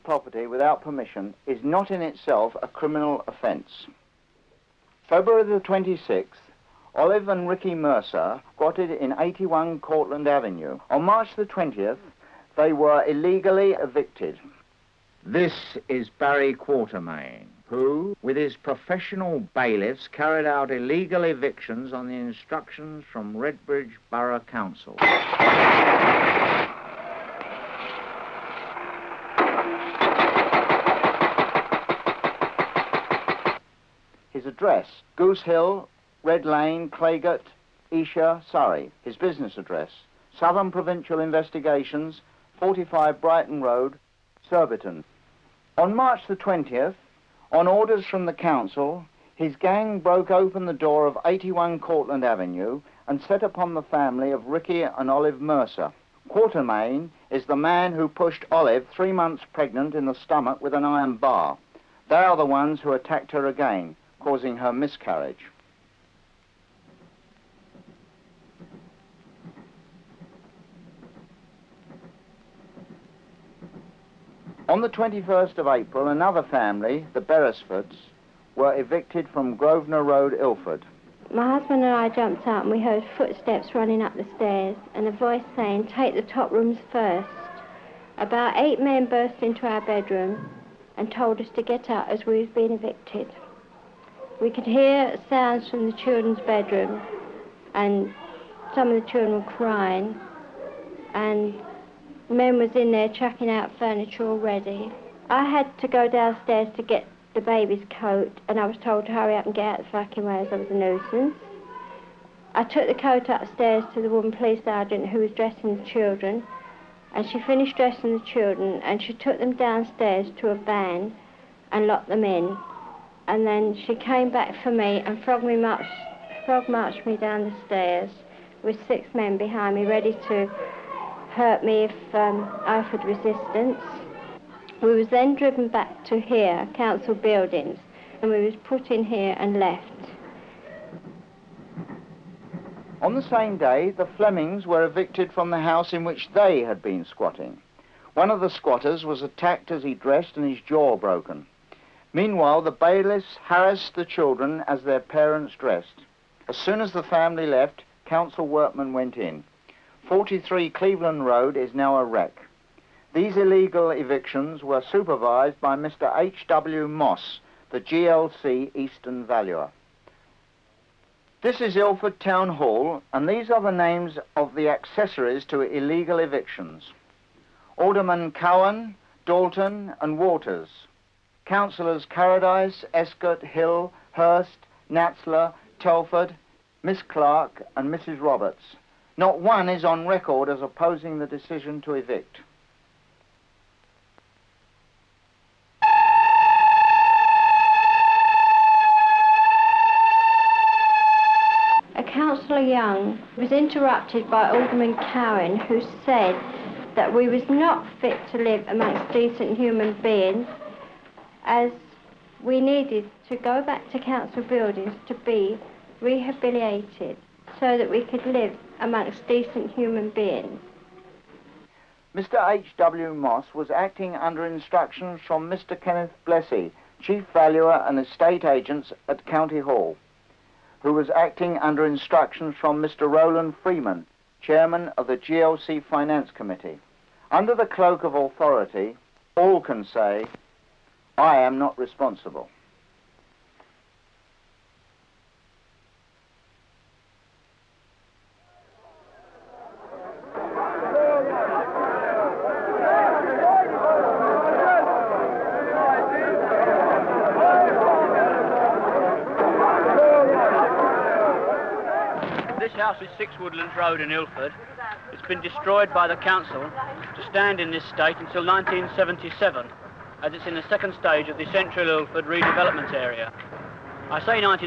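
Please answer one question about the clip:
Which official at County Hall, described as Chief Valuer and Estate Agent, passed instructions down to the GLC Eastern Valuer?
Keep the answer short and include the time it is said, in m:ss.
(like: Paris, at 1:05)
Kenneth Blessey, at 3:45.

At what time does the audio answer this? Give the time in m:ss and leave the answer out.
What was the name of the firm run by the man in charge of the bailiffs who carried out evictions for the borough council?
0:40.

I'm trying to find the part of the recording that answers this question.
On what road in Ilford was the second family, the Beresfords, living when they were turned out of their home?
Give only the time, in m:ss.
1:19.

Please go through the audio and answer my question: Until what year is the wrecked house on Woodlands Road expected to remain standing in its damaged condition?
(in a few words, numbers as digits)
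1977.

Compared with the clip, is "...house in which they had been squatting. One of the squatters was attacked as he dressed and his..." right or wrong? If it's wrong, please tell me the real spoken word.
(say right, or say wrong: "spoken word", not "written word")
right.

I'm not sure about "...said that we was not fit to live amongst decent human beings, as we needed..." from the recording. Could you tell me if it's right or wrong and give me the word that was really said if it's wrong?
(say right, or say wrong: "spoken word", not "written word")
right.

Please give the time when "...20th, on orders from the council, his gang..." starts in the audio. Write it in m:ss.
0:46.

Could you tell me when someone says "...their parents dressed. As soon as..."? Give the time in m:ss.
2:34.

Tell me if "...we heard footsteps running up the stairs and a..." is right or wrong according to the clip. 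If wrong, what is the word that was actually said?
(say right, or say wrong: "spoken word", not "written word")
right.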